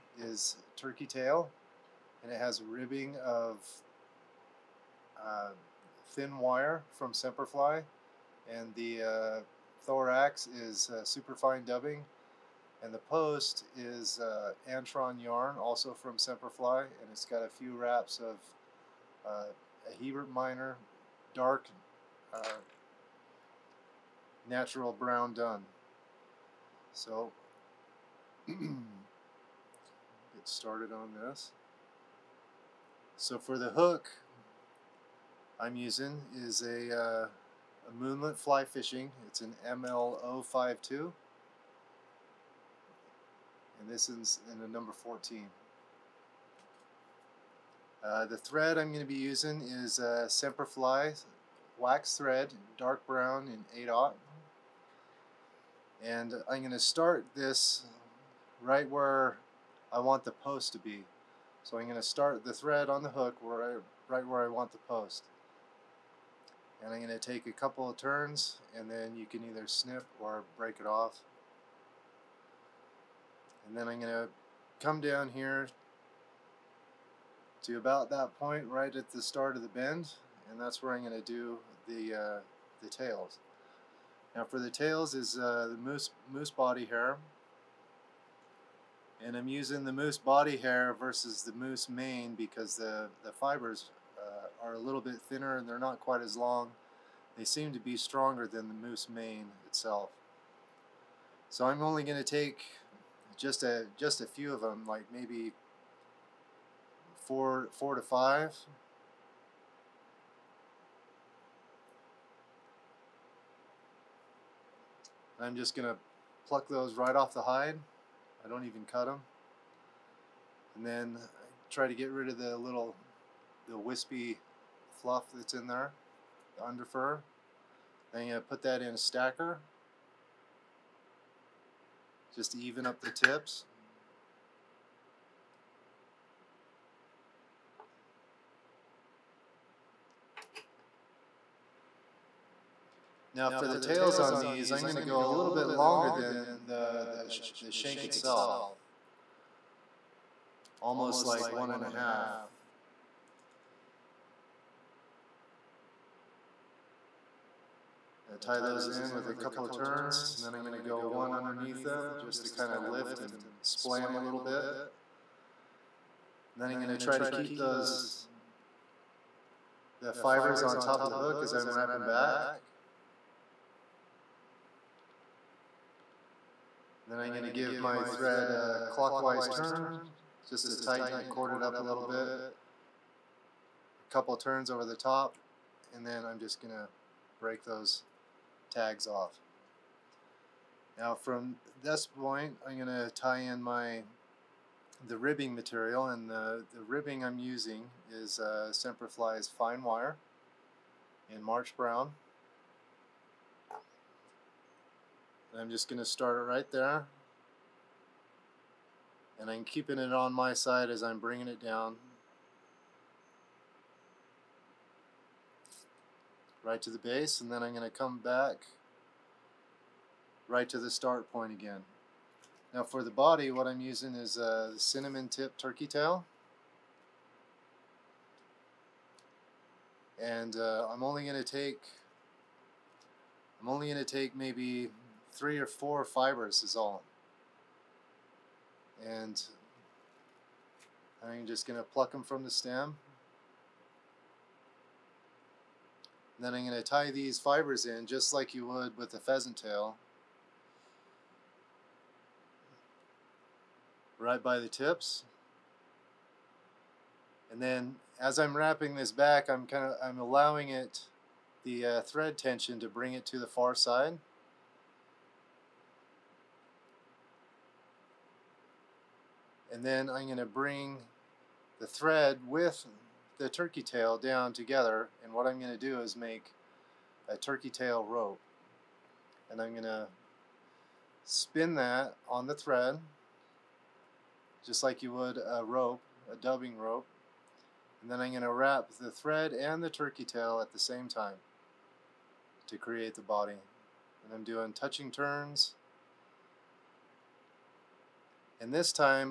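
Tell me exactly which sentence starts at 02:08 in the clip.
Then you put that in a stacker just to even up the tips.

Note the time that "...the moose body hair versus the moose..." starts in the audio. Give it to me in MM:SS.
01:29.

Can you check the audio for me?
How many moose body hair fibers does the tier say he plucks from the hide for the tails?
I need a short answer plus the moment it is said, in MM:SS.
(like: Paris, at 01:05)
4 to 5, at 01:47.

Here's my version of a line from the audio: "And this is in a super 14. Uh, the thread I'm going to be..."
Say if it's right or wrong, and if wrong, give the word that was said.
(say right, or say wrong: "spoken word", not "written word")
wrong: "number", not "super".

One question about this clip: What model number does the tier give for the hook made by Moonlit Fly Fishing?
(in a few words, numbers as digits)
ML052.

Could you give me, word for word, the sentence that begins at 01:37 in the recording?
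They seem to be stronger than the moose mane itself.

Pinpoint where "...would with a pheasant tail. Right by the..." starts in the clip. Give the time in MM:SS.
04:08.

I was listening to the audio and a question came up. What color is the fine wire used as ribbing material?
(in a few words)
March Brown.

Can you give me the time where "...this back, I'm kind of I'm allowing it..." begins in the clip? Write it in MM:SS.
04:18.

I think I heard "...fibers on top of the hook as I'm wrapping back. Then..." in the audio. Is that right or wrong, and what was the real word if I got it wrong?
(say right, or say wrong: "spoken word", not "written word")
right.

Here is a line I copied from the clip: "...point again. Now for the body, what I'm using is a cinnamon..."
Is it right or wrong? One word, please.
right.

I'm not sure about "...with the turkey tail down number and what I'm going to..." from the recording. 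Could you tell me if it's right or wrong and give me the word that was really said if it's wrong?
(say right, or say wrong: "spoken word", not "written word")
wrong: "together", not "number".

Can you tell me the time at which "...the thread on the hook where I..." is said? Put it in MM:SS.
01:02.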